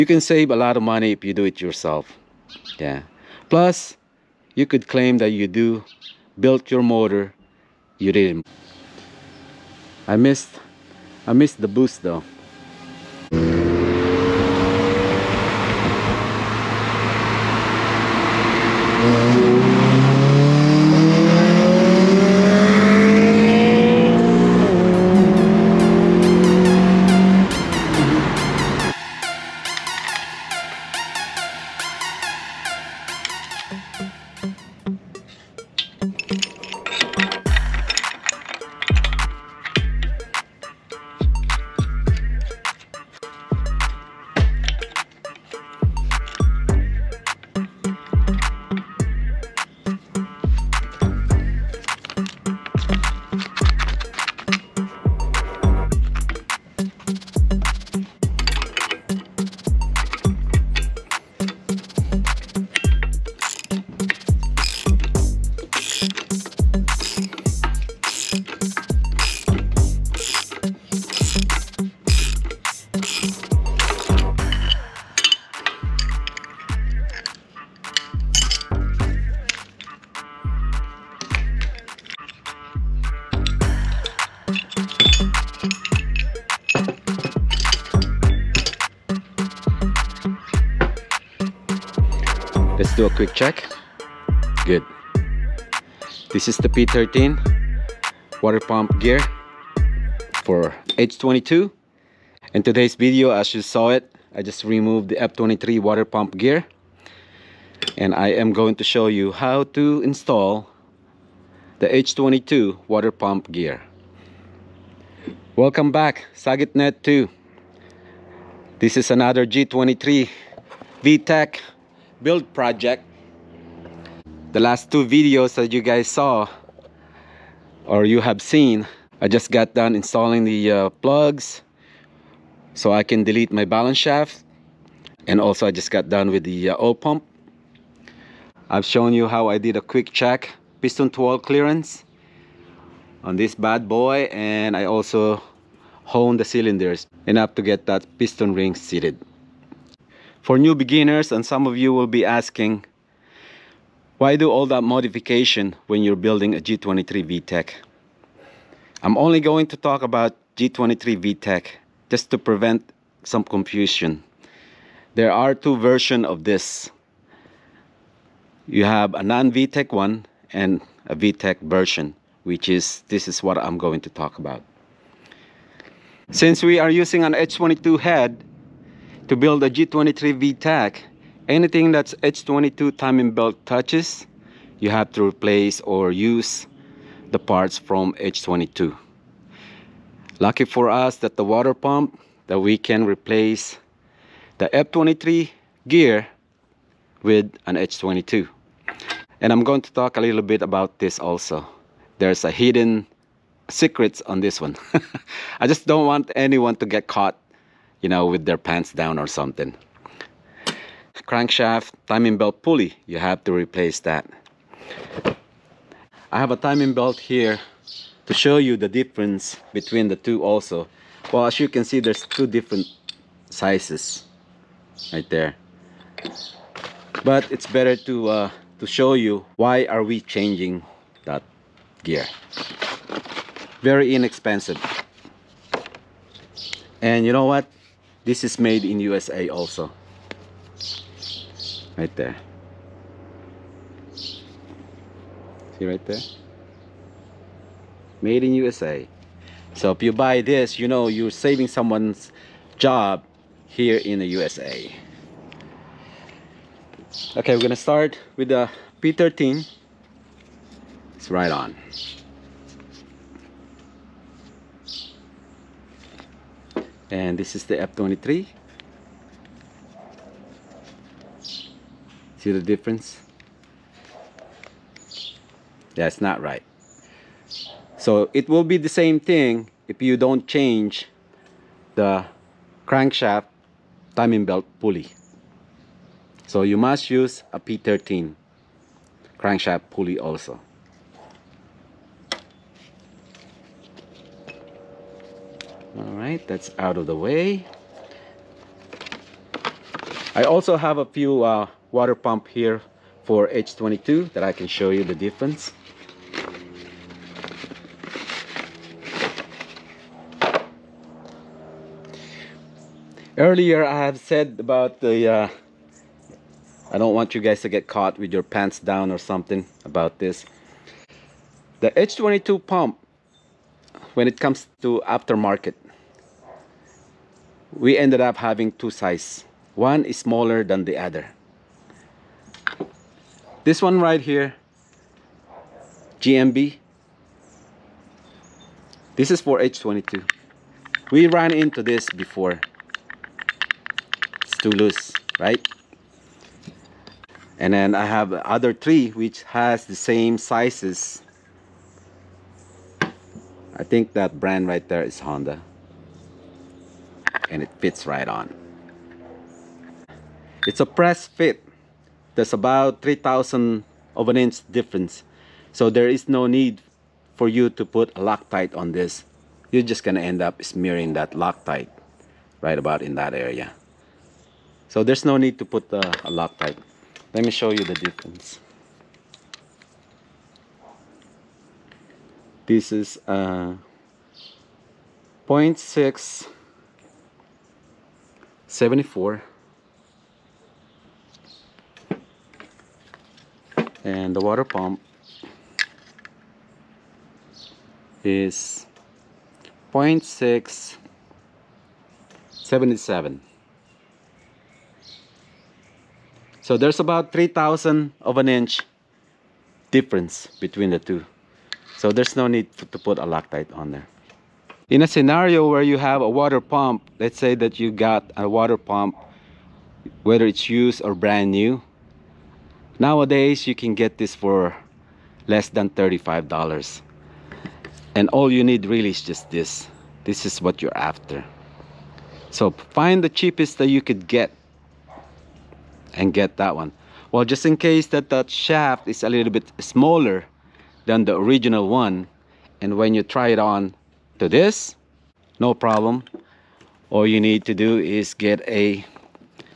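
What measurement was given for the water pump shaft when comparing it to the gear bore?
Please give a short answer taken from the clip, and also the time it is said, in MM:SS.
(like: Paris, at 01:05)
0.677, at 06:39.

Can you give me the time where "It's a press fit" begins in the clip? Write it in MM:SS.
06:00.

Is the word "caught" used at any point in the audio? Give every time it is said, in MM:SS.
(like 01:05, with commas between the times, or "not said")
03:27, 05:17.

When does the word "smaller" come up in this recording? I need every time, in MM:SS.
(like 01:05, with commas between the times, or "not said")
05:30, 07:19.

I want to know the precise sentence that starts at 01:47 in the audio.
And I am going to show you how to install the H22 water pump gear.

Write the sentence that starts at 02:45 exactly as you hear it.
There are two versions of this.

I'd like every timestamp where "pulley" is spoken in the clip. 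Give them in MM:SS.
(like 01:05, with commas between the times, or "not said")
03:32, 04:44, 04:49.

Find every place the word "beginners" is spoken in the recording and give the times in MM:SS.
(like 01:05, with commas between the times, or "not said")
02:30.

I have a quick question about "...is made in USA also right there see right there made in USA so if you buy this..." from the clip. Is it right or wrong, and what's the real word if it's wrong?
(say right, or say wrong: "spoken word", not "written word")
right.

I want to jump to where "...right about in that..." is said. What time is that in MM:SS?
06:12.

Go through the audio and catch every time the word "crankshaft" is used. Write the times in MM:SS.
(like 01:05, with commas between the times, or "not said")
03:31, 04:42, 04:49.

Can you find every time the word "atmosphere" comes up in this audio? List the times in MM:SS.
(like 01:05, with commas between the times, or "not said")
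not said.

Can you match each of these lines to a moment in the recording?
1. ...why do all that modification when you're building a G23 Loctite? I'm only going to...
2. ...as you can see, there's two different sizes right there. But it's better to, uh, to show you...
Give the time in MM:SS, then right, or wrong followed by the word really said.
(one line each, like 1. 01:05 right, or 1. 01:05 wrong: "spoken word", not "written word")
1. 02:34 wrong: "VTEC", not "Loctite"
2. 03:41 right.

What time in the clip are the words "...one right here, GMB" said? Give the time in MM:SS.
05:33.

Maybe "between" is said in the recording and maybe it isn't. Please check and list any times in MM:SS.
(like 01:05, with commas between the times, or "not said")
03:39, 06:50.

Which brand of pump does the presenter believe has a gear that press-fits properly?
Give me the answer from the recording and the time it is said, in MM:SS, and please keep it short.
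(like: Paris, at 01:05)
Honda, at 05:55.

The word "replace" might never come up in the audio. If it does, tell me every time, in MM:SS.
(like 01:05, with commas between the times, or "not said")
03:05, 03:13, 03:33.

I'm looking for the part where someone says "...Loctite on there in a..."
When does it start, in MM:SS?
06:53.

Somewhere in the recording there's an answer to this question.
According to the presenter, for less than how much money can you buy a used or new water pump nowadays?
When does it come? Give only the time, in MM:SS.
07:05.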